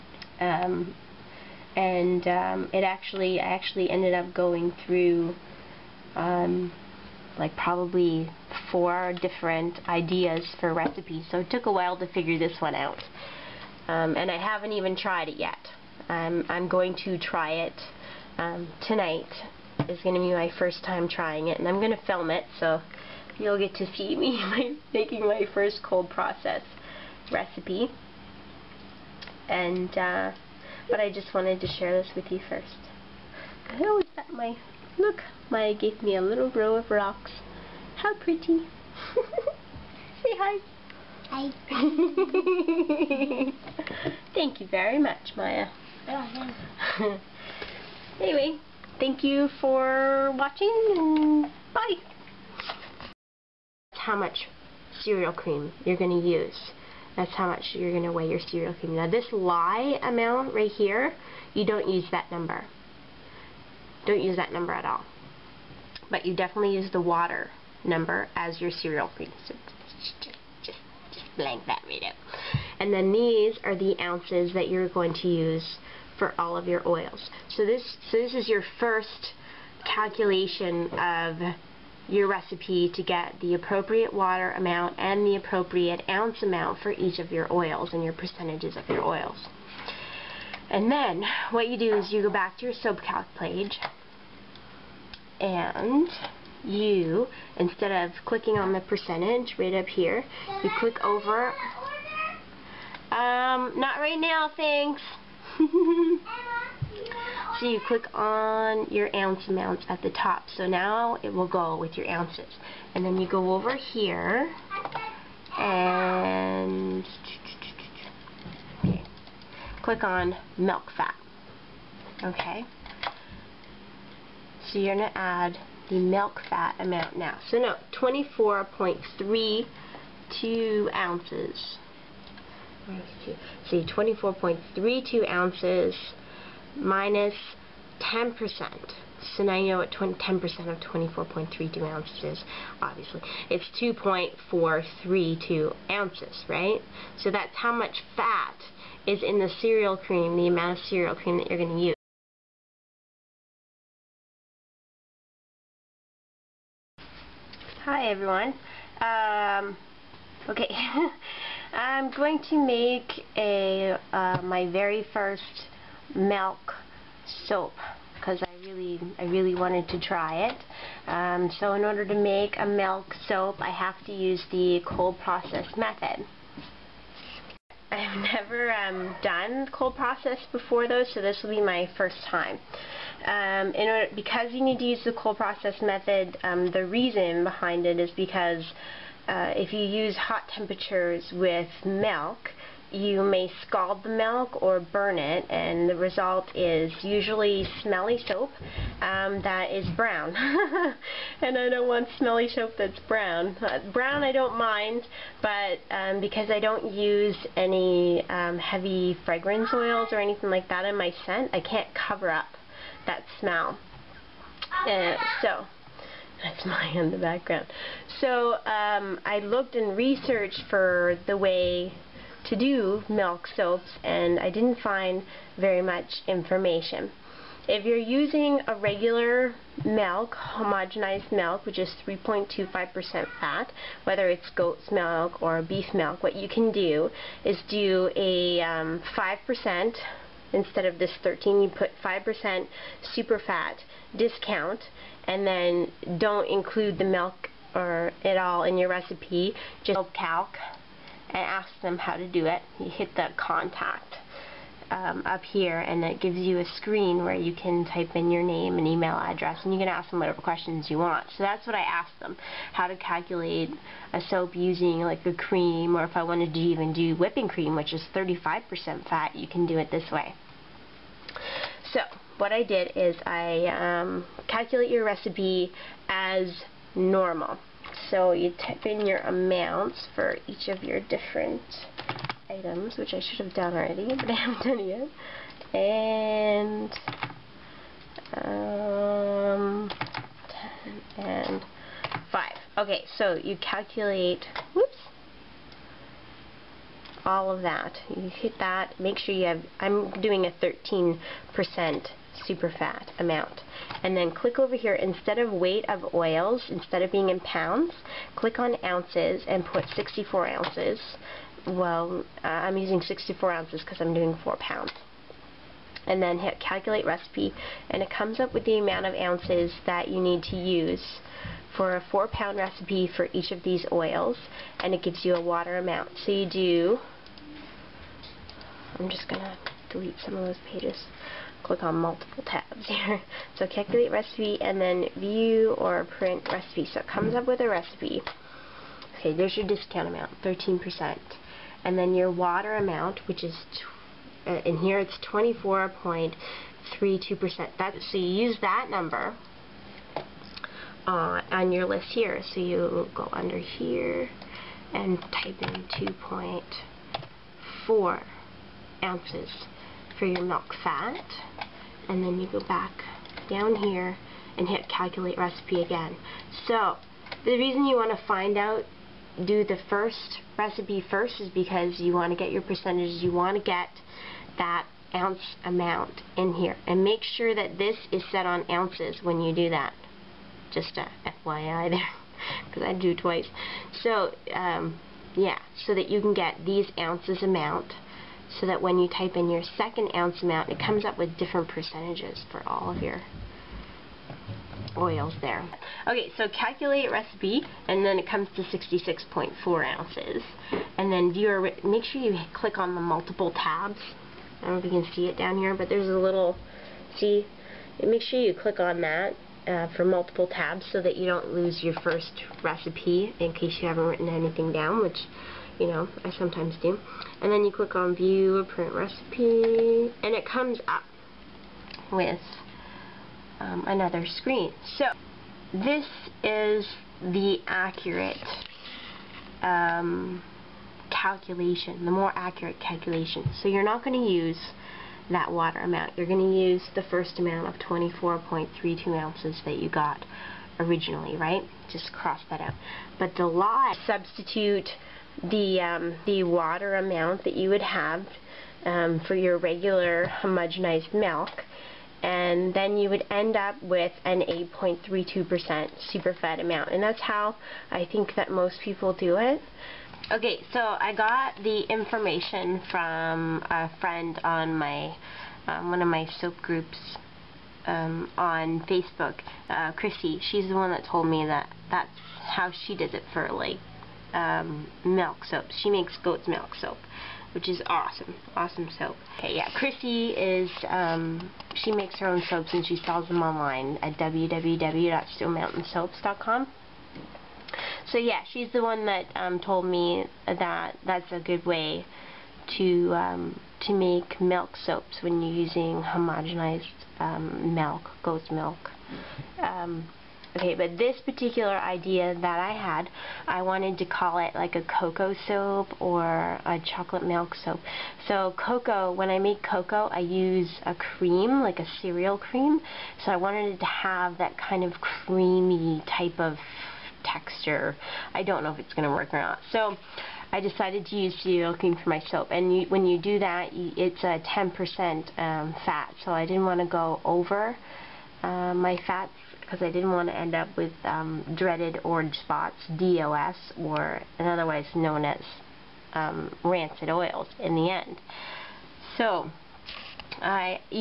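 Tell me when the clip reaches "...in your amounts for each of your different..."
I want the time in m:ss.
4:38.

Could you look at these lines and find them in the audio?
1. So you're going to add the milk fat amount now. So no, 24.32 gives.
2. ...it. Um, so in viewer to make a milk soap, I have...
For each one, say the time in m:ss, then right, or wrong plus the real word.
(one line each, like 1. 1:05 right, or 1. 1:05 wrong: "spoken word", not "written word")
1. 2:04 wrong: "ounces", not "gives"
2. 2:50 wrong: "order", not "viewer".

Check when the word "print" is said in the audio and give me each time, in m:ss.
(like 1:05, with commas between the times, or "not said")
5:36, 6:58.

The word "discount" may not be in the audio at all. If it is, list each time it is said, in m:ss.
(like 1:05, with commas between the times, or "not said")
4:04, 5:39.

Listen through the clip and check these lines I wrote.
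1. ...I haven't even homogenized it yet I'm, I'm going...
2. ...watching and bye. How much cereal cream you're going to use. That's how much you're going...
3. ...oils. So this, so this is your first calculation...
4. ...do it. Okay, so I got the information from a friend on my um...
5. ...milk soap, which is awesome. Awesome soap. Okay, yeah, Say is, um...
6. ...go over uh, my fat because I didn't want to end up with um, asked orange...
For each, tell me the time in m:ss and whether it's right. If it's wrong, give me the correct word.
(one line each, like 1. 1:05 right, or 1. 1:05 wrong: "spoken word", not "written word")
1. 0:14 wrong: "tried", not "homogenized"
2. 0:50 right
3. 1:16 right
4. 7:39 right
5. 7:56 wrong: "Chrissy", not "Say"
6. 8:46 wrong: "dreaded", not "asked".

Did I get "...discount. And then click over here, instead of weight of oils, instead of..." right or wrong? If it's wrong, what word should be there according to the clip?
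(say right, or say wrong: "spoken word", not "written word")
wrong: "amount", not "discount".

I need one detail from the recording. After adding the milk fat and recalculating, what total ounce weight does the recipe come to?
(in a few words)
66.4 ounces.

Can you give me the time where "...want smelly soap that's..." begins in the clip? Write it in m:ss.
3:21.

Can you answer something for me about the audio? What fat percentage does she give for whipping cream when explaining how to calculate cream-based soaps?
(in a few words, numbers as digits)
35%.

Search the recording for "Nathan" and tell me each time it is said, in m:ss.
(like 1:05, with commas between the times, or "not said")
not said.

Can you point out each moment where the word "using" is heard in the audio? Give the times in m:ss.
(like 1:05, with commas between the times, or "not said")
3:47, 4:24, 5:12, 8:15.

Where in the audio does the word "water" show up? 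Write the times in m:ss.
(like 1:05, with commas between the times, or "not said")
1:07, 1:24, 5:25, 5:42, 7:15, 7:26.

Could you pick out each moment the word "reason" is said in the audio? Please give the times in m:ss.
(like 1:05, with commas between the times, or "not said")
3:06, 6:07.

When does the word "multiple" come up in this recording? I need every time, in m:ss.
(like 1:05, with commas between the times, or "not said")
5:31, 6:43, 6:50.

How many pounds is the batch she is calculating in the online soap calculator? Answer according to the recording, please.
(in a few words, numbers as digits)
4 pounds.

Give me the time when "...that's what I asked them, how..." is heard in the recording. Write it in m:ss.
4:21.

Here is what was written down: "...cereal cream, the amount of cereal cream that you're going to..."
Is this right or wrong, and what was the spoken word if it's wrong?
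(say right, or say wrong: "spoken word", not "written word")
right.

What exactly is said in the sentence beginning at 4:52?
Okay, so you calculate, whoops, all of that.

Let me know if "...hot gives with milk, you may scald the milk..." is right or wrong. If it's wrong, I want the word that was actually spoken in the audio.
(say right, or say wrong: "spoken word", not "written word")
wrong: "temperatures", not "gives".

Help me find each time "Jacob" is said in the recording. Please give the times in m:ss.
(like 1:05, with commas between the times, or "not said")
not said.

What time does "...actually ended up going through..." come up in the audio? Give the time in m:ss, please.
0:03.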